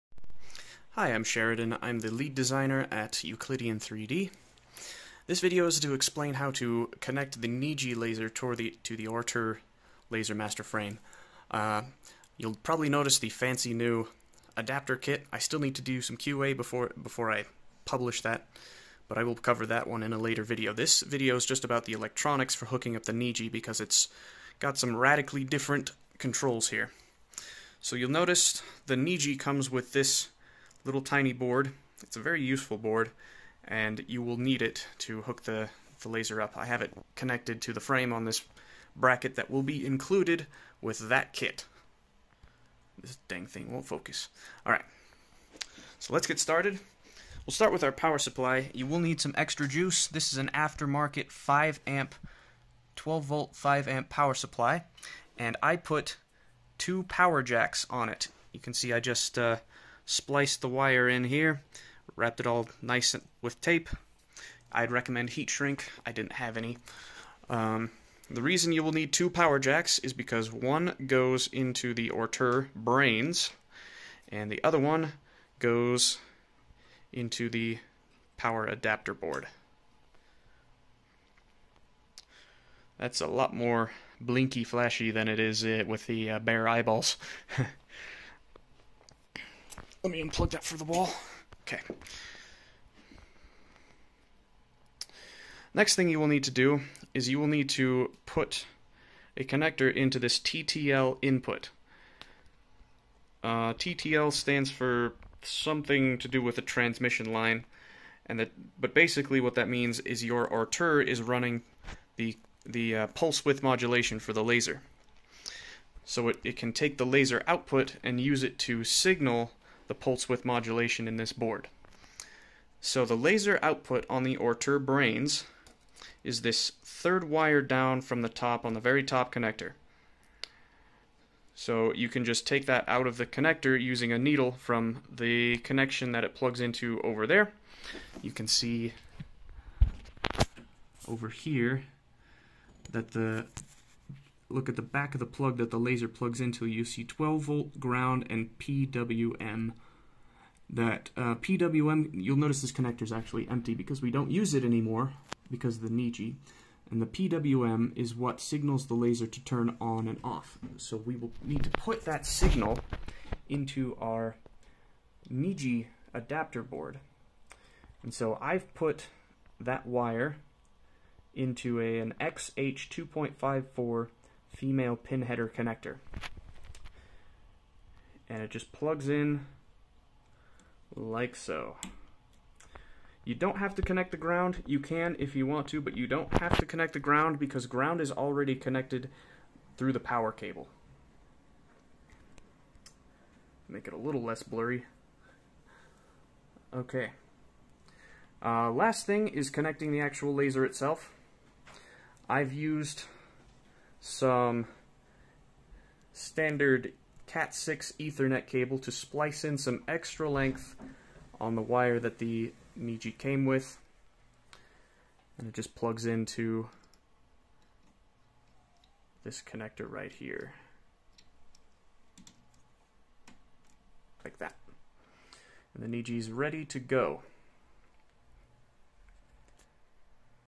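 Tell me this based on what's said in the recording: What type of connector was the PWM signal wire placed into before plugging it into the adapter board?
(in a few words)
XH 2.54 female pin header.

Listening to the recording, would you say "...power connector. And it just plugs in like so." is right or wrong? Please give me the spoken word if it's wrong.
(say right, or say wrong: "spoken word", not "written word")
wrong: "header", not "power".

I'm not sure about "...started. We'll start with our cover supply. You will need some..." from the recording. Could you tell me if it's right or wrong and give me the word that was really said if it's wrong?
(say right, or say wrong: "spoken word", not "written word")
wrong: "power", not "cover".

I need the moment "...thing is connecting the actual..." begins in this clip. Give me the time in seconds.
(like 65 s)
199 s.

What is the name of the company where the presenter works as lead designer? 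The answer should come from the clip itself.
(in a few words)
Euclidean 3D.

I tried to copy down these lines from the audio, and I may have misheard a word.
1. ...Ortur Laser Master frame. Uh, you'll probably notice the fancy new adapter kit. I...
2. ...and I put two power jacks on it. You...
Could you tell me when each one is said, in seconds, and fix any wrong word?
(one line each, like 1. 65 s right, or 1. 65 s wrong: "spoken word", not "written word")
1. 9 s right
2. 55 s right.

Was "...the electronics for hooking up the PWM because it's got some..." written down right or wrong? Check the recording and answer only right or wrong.
wrong.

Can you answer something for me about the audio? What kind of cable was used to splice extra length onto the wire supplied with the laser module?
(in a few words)
Cat6 Ethernet cable.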